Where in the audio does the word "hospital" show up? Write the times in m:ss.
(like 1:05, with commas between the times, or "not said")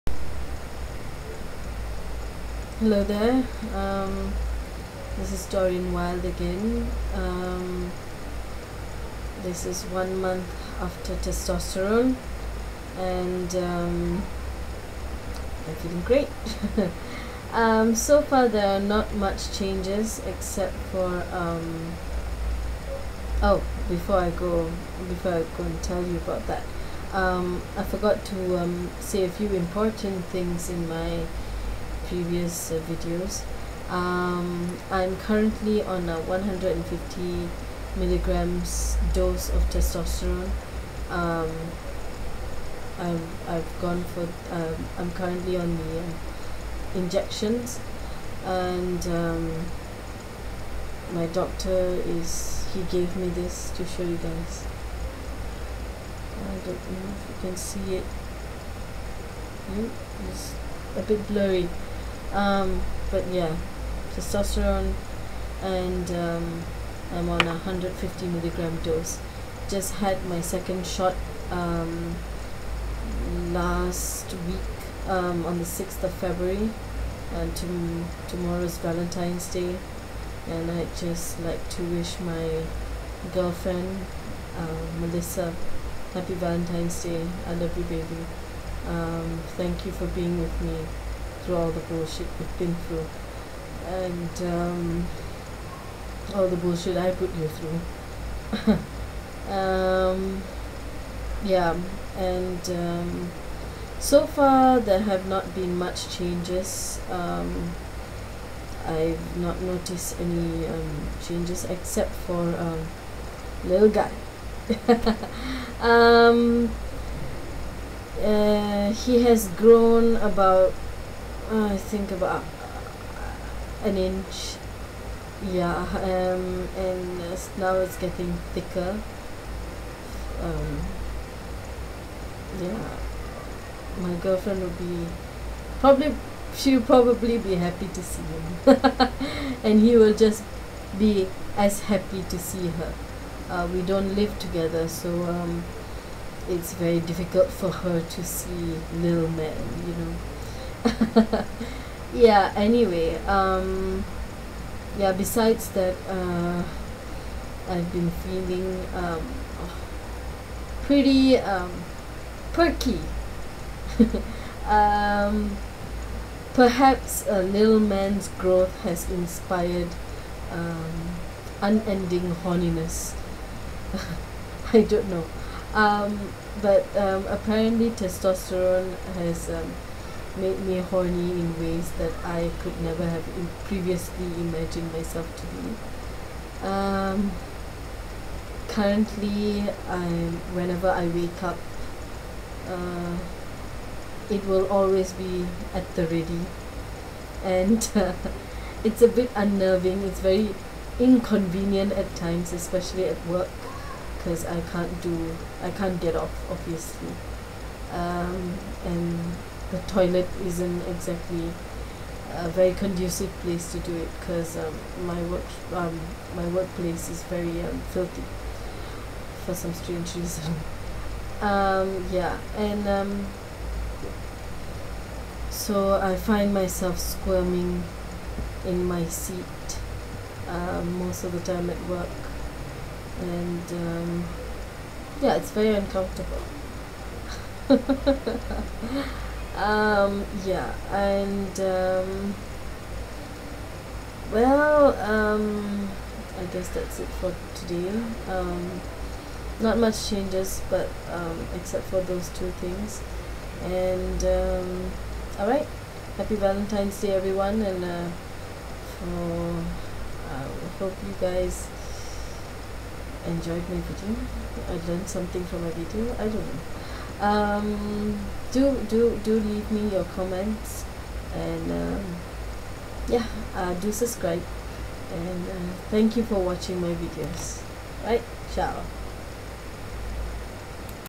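not said.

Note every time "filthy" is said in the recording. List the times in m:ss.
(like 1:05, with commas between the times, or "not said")
3:37.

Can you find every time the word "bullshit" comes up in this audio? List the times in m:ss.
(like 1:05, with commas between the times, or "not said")
1:31, 1:36.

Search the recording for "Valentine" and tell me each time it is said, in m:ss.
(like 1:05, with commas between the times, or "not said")
1:18, 1:26, 4:16.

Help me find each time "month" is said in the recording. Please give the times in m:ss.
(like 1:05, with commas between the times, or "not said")
0:10.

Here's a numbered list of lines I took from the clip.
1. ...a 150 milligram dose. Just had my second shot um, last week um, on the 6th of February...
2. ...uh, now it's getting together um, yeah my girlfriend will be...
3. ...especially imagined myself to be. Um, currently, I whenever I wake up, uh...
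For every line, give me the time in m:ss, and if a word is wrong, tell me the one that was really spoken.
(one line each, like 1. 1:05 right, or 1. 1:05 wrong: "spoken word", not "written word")
1. 1:07 right
2. 2:07 wrong: "thicker", not "together"
3. 3:03 wrong: "previously", not "especially".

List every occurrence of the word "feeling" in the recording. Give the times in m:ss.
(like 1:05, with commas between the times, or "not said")
0:15, 2:38.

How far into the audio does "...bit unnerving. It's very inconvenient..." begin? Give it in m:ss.
3:19.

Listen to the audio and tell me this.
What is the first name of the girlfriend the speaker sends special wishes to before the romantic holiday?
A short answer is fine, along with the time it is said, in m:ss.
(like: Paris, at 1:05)
Melissa, at 1:25.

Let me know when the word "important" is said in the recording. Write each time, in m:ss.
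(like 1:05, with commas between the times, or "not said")
0:29.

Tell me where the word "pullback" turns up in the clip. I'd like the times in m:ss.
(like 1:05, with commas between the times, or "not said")
not said.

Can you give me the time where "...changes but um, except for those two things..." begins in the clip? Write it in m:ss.
4:10.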